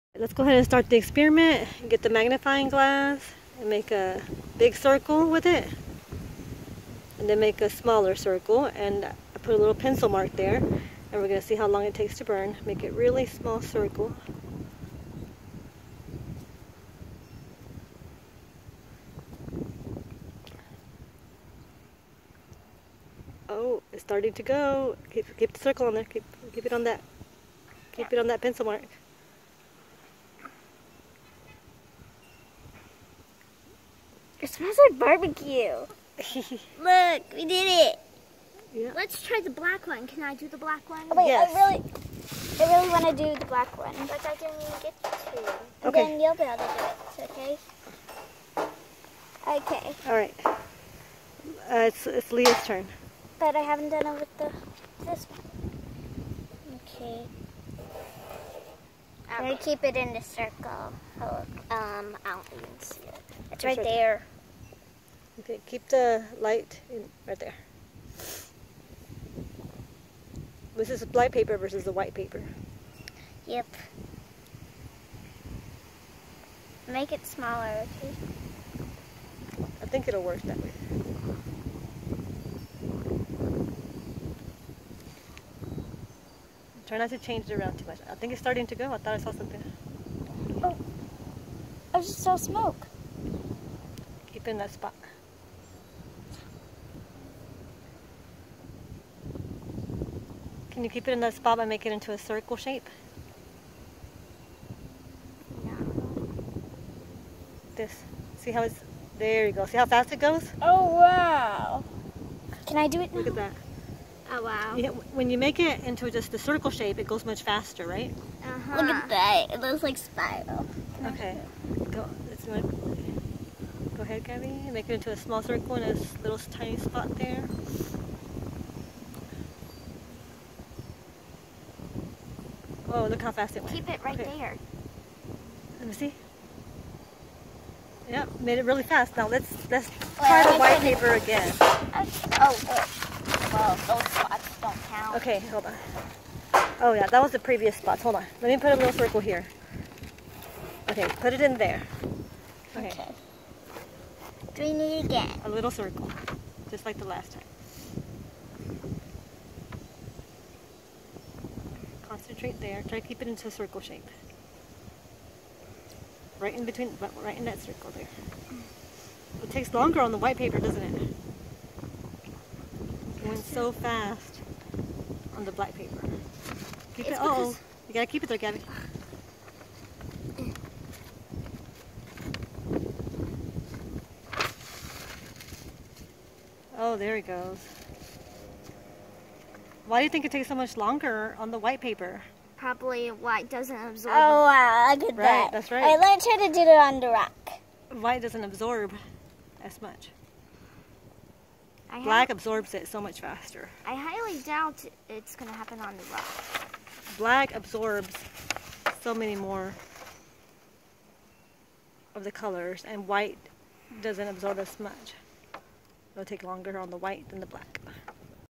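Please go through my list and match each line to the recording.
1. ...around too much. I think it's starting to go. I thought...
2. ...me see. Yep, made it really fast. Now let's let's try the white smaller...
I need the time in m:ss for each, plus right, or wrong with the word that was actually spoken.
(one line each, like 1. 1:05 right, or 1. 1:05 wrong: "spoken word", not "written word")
1. 1:27 right
2. 2:15 wrong: "paper", not "smaller".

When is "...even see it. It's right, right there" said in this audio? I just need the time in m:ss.
1:02.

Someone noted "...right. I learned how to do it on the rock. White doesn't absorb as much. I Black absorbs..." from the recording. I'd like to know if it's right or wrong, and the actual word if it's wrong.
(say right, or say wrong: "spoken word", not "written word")
right.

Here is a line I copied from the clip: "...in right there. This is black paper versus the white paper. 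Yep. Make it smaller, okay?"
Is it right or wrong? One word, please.
right.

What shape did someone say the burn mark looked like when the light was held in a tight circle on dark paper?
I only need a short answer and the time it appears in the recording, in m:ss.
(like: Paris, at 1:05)
spiral, at 1:59.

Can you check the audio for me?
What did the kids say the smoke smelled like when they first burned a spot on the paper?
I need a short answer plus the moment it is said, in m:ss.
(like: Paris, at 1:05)
barbecue, at 0:34.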